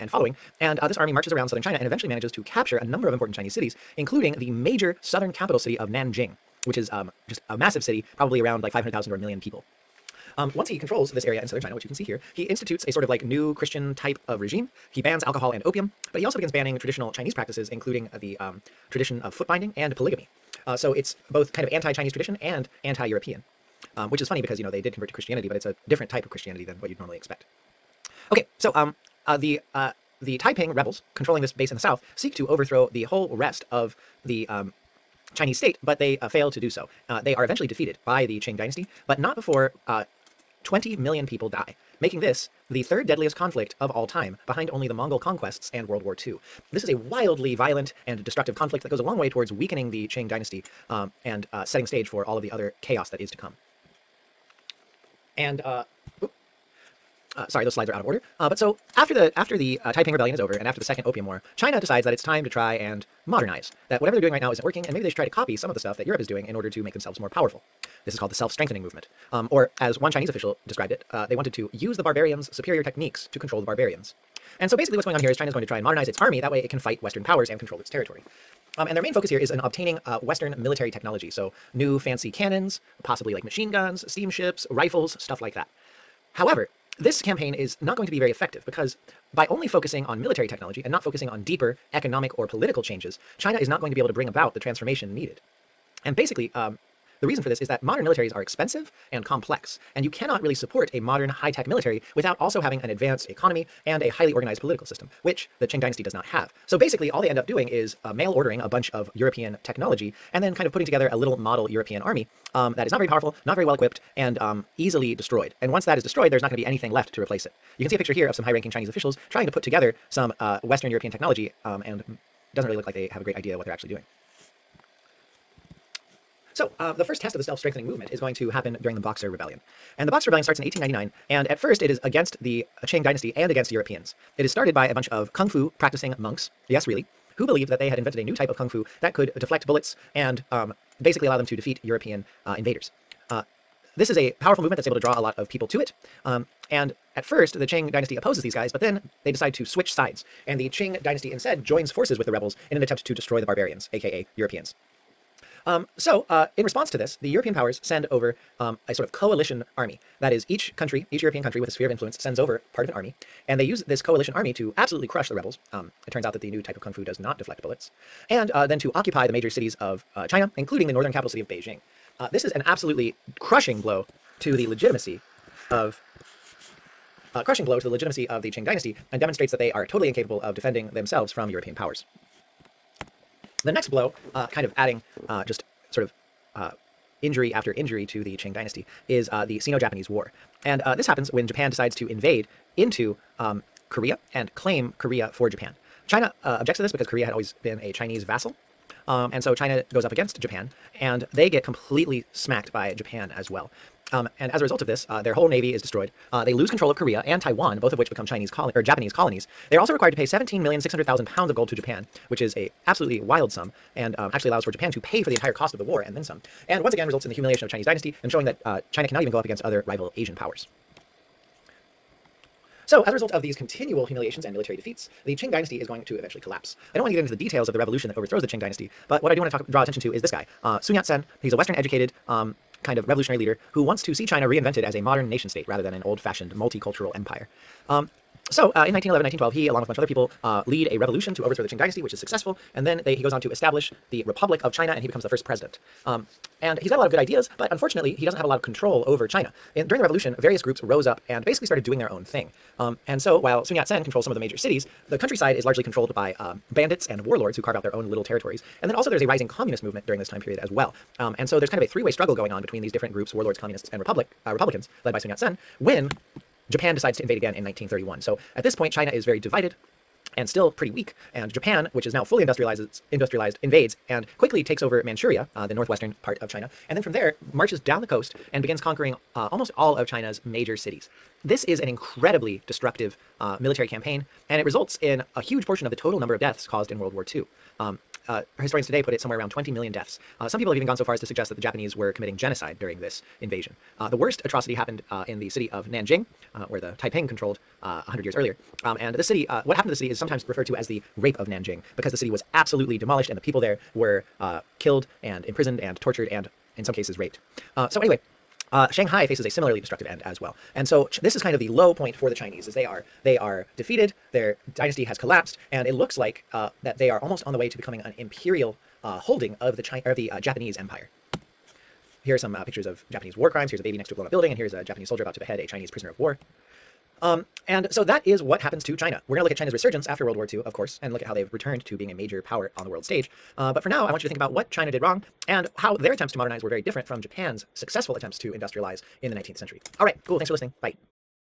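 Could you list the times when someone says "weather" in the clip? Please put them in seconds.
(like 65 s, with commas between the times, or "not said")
not said.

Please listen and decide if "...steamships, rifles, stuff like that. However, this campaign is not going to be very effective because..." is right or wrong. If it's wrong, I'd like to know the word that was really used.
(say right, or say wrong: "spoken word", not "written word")
right.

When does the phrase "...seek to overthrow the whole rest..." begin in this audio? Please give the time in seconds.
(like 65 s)
32 s.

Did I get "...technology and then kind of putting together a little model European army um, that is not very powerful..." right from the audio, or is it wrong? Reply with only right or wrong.
right.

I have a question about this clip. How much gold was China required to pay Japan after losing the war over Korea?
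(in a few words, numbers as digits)
17,600,000 pounds.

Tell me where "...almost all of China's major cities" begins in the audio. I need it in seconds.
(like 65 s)
279 s.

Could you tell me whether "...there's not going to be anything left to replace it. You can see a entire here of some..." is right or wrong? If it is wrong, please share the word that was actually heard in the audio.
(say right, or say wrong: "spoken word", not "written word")
wrong: "picture", not "entire".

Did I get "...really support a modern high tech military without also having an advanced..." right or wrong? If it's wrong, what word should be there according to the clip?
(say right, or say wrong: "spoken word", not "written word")
right.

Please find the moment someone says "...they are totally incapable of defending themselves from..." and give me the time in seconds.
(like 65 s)
179 s.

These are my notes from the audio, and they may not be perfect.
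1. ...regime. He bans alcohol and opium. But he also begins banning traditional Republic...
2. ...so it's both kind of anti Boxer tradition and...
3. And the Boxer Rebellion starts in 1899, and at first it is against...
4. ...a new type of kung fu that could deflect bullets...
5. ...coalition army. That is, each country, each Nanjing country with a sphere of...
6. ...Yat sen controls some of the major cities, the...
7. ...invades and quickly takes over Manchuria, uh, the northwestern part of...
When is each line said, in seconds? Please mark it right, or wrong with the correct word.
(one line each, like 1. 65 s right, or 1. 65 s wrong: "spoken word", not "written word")
1. 14 s wrong: "Chinese", not "Republic"
2. 20 s wrong: "Chinese", not "Boxer"
3. 129 s right
4. 138 s right
5. 159 s wrong: "European", not "Nanjing"
6. 253 s right
7. 273 s right.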